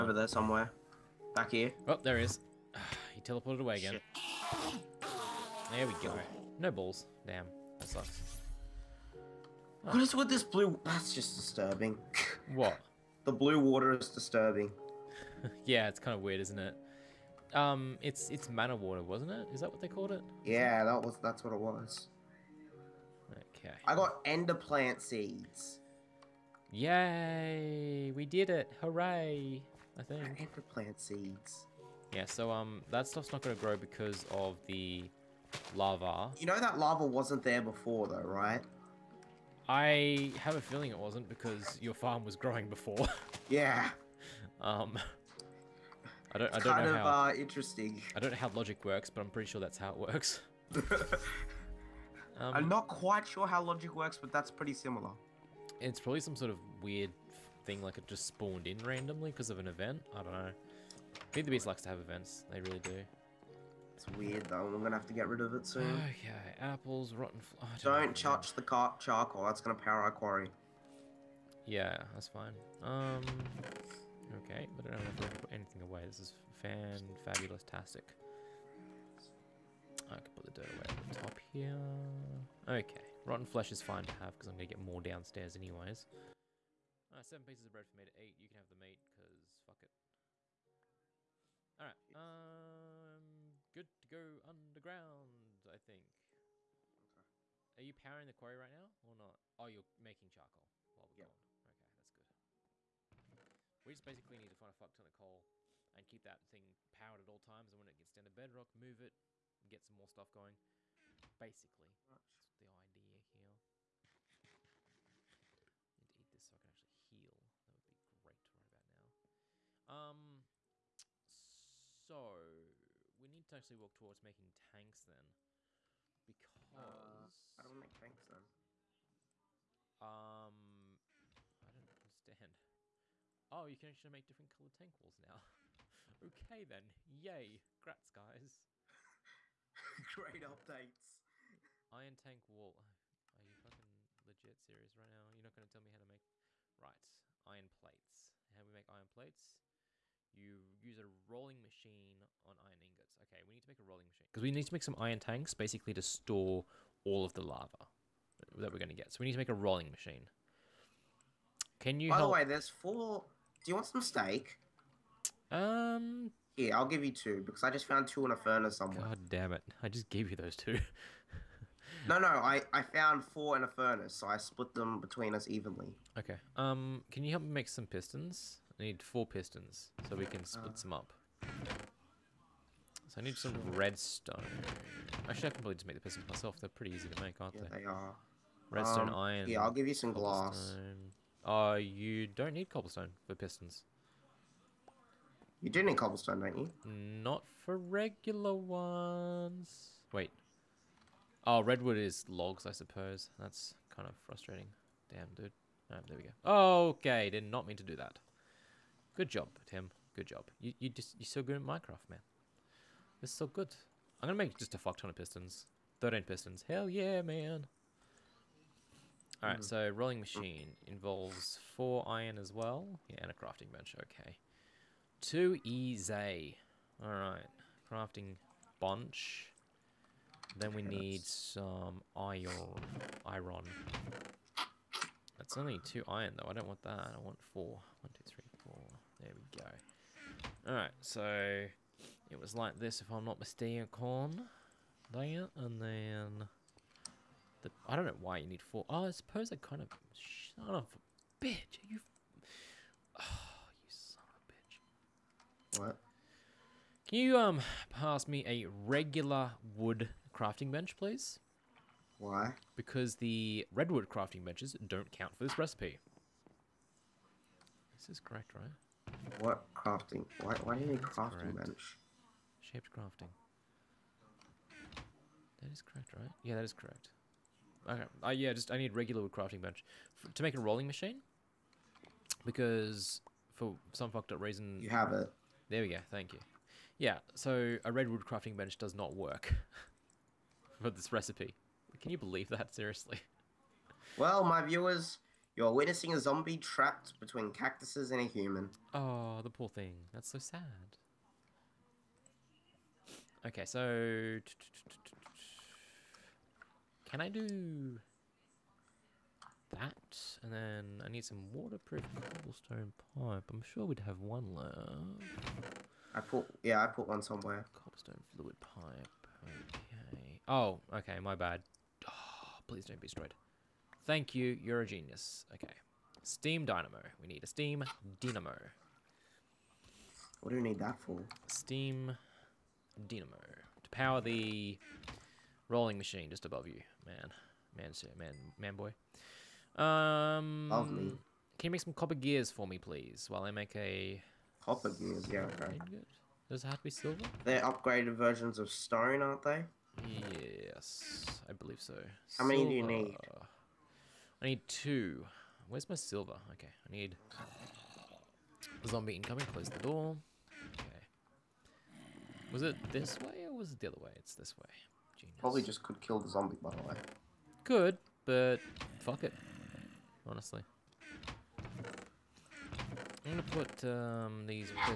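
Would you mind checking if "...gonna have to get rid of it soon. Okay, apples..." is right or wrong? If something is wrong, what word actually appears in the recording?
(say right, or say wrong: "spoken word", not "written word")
right.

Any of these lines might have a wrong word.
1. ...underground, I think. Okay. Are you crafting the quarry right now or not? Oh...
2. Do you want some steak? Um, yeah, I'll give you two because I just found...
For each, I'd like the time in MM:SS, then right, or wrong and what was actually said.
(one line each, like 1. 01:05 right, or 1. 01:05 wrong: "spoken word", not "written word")
1. 01:34 wrong: "powering", not "crafting"
2. 02:43 right.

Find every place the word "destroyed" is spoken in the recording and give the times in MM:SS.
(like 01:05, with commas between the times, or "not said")
05:23.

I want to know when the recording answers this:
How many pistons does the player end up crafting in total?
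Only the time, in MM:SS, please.
03:36.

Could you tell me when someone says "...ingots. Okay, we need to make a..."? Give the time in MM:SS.
02:32.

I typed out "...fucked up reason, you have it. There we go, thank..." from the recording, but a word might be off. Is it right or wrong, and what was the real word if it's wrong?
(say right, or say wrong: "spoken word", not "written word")
right.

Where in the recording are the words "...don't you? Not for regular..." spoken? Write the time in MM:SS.
03:16.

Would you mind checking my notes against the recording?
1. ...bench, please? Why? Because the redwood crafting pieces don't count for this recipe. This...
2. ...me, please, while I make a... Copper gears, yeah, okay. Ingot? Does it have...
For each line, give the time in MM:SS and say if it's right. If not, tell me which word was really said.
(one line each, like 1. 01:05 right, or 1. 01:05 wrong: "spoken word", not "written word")
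1. 04:20 wrong: "benches", not "pieces"
2. 05:42 right.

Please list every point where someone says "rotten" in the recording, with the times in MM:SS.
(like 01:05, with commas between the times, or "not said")
01:07, 01:23.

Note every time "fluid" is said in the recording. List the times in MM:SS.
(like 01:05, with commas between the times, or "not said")
05:18.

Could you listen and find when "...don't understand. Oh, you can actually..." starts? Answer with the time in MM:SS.
02:11.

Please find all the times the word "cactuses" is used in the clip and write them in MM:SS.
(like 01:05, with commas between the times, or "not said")
04:57.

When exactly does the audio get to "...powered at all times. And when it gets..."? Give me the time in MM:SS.
01:46.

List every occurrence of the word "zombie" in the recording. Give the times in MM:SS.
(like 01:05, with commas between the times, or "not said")
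04:56, 05:58, 06:06.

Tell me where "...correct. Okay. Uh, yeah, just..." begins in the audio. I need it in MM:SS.
04:36.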